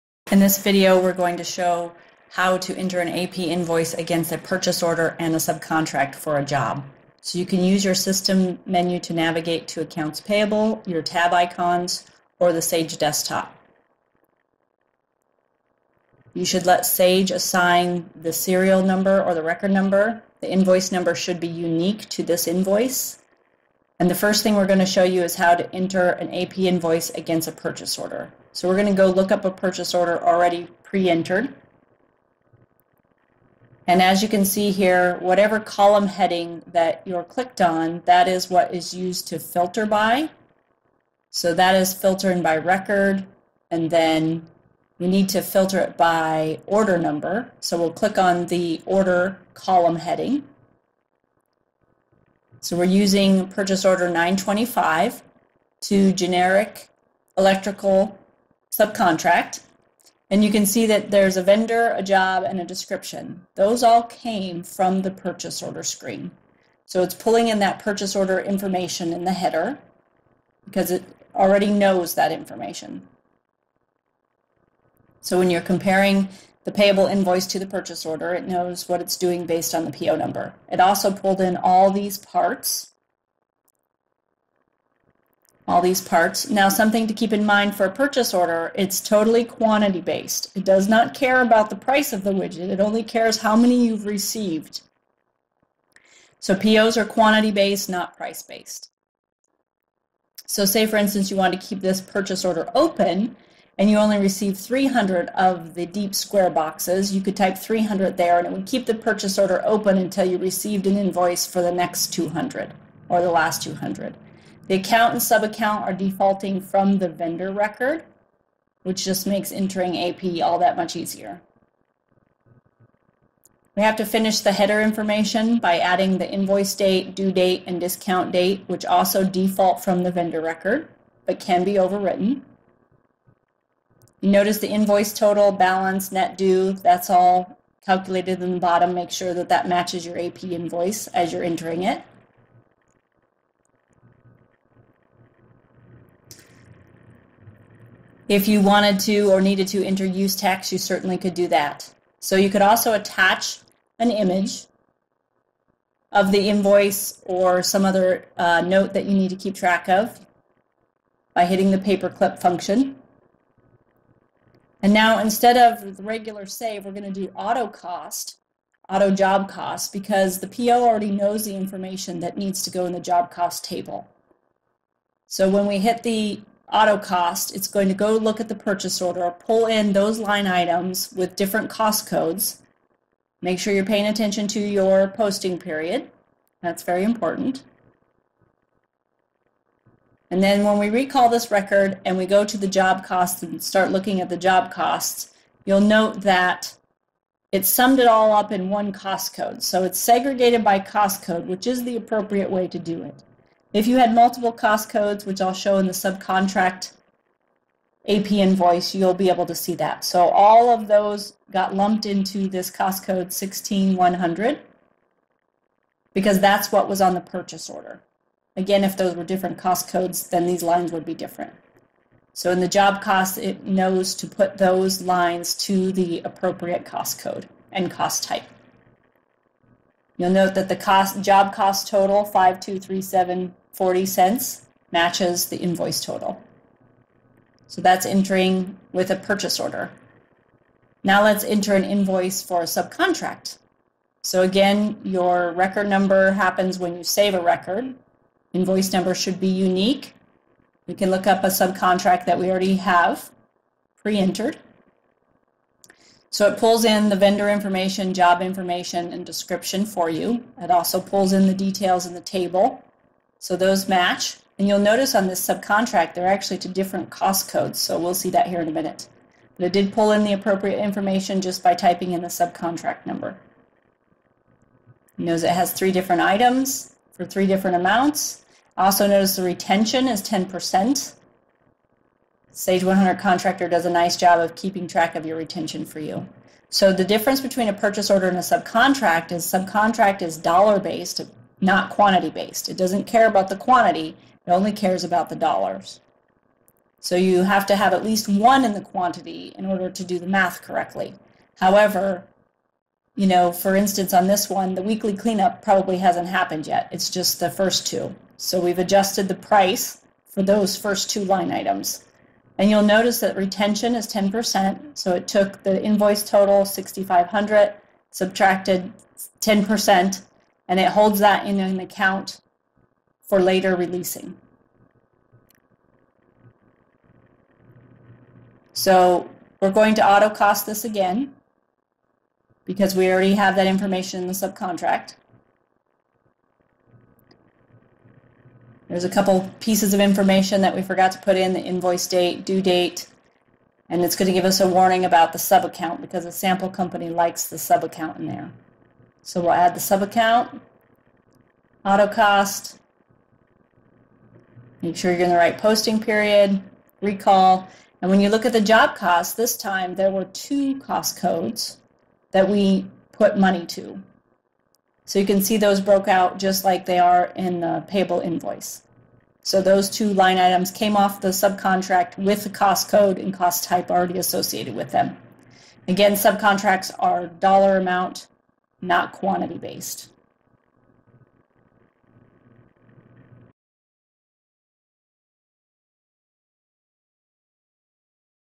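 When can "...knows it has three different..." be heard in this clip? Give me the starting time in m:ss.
4:35.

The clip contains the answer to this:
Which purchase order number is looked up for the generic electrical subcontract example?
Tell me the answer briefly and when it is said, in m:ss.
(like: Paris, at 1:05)
925, at 0:54.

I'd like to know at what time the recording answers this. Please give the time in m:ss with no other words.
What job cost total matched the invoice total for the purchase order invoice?
3:52.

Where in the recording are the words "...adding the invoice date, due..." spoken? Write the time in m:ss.
2:05.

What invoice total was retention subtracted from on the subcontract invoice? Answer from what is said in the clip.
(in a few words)
6,500.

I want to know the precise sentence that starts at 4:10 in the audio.
We can look up a subcontract that we already have pre-entered.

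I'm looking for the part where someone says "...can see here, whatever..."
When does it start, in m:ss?
0:34.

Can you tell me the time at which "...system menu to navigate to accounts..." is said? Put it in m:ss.
0:07.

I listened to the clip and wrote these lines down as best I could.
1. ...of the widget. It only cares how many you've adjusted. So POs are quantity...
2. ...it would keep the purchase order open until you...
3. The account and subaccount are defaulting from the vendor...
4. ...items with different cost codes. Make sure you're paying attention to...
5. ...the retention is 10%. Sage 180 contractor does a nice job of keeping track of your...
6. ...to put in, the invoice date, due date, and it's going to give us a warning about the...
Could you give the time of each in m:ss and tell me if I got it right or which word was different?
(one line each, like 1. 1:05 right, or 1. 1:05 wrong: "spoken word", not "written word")
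1. 1:32 wrong: "received", not "adjusted"
2. 1:48 right
3. 1:54 right
4. 3:00 right
5. 4:39 wrong: "100", not "180"
6. 5:41 right.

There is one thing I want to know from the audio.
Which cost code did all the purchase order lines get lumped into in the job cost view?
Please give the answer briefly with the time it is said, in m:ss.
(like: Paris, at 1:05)
16100, at 3:33.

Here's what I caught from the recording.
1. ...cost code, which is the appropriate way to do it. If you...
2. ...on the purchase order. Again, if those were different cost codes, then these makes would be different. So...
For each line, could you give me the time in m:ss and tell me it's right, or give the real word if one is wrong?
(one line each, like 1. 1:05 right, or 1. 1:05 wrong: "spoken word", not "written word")
1. 3:20 right
2. 3:37 wrong: "lines", not "makes".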